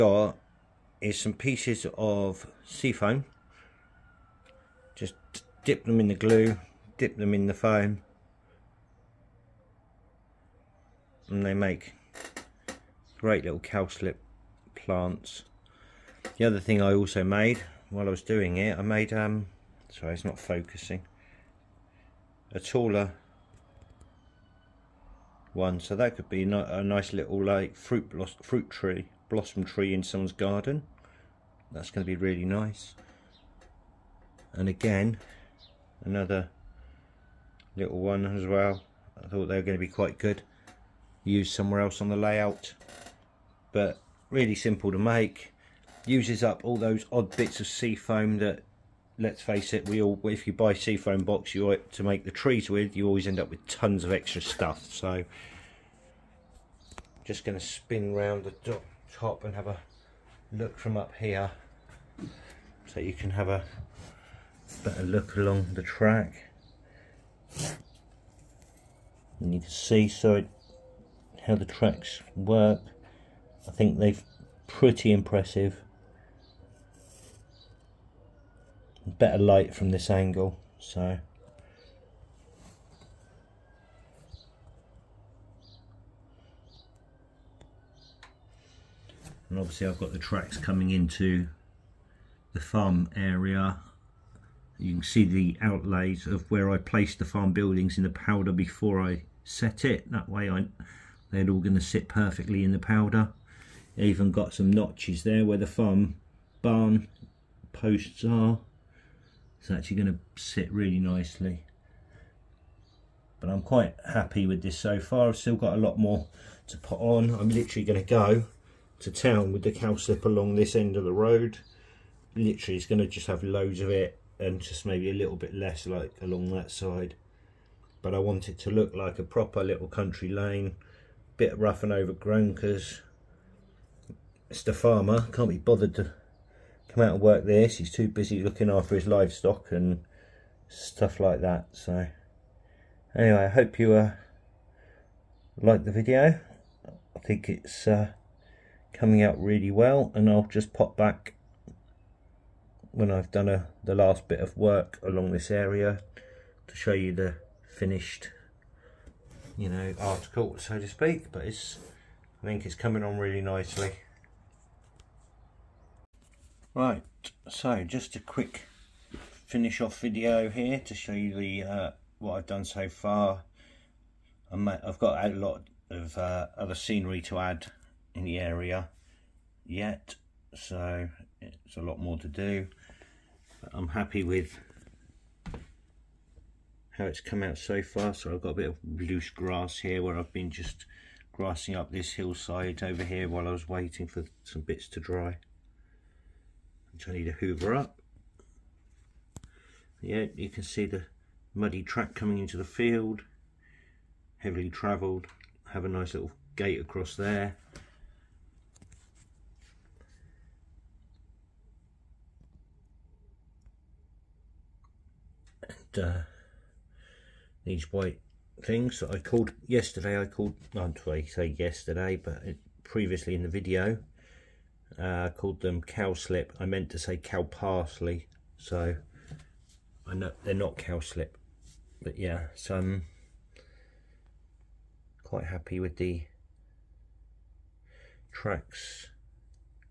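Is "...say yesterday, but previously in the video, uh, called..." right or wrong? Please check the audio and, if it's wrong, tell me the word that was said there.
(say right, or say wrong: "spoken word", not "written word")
right.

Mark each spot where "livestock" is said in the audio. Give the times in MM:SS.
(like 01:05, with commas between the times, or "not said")
02:19.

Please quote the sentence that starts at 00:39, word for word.
I thought they were going to be quite good.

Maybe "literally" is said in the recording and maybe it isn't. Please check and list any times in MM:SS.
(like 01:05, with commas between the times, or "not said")
01:57, 02:02.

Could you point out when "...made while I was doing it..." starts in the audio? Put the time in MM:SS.
00:17.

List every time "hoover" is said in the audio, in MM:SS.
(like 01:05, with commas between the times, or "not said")
03:17.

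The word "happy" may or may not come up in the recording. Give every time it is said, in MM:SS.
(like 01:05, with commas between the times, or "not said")
01:54, 03:03, 03:55.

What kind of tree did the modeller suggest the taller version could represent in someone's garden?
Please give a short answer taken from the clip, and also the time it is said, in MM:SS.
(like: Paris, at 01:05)
Blossom tree, at 00:29.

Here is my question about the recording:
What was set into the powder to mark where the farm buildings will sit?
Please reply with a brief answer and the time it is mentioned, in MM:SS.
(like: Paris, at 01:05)
The outlays, at 01:35.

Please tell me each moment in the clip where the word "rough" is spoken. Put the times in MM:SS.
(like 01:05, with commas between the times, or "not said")
02:11.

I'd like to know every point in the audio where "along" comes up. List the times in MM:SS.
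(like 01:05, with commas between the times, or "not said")
01:05, 02:00, 02:06, 02:35.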